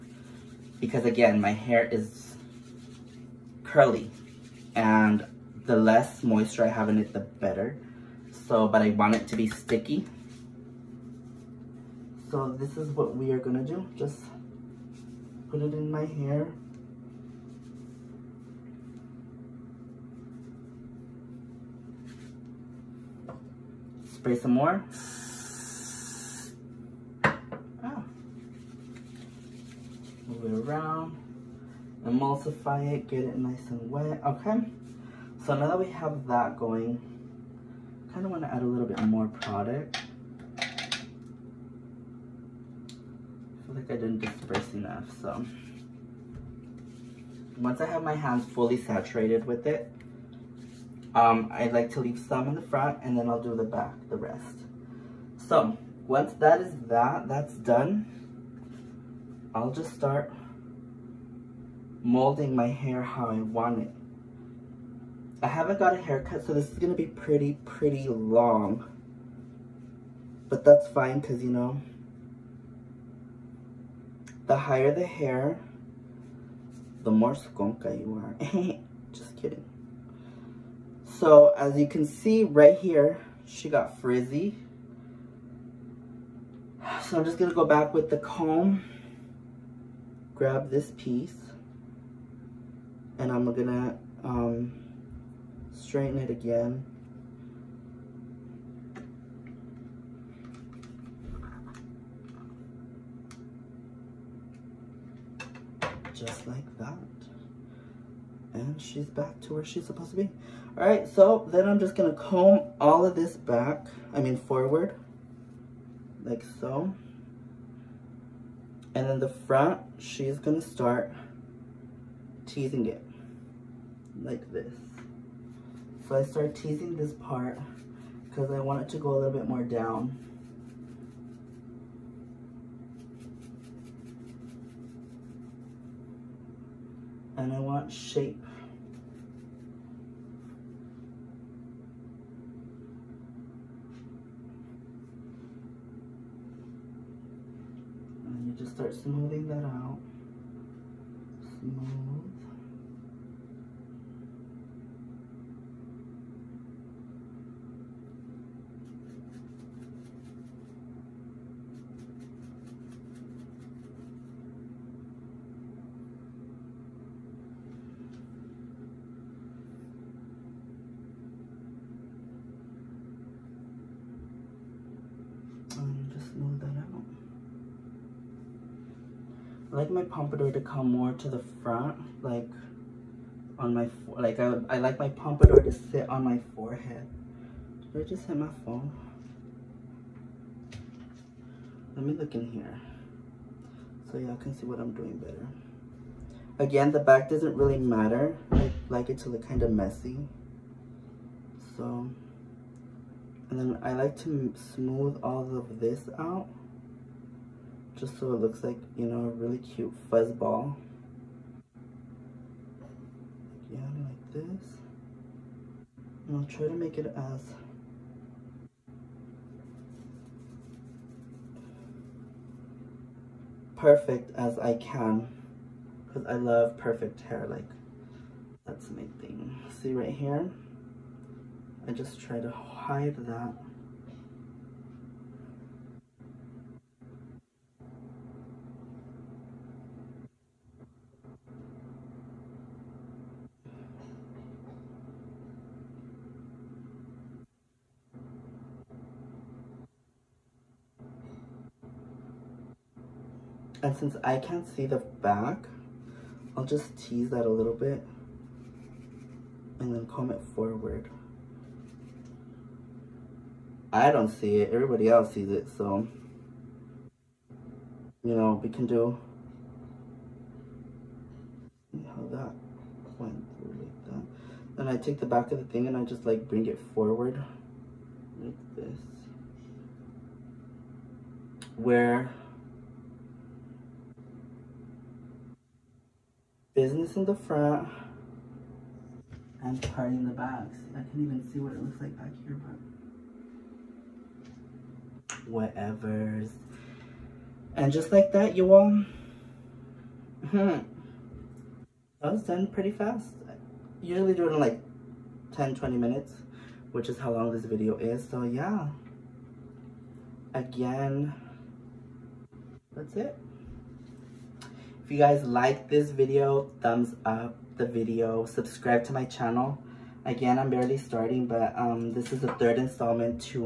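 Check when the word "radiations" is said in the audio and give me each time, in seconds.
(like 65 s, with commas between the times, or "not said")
not said.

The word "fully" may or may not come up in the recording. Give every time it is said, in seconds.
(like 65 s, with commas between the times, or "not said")
48 s.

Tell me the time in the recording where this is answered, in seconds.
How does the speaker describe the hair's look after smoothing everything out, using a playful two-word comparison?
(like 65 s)
210 s.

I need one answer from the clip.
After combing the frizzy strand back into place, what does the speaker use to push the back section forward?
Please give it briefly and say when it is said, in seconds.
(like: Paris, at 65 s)
the back of the thing, at 275 s.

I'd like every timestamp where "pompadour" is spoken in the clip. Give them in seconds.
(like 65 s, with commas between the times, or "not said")
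180 s, 185 s.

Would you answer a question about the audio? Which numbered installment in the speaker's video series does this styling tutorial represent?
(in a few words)
third.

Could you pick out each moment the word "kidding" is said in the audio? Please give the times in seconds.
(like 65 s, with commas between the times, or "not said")
79 s.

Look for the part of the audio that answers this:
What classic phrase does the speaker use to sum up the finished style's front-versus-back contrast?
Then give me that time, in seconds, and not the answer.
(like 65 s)
286 s.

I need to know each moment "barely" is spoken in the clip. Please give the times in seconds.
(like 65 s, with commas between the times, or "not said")
320 s.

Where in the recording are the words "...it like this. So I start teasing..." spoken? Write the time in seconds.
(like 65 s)
122 s.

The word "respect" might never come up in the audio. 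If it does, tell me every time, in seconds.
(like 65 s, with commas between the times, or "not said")
not said.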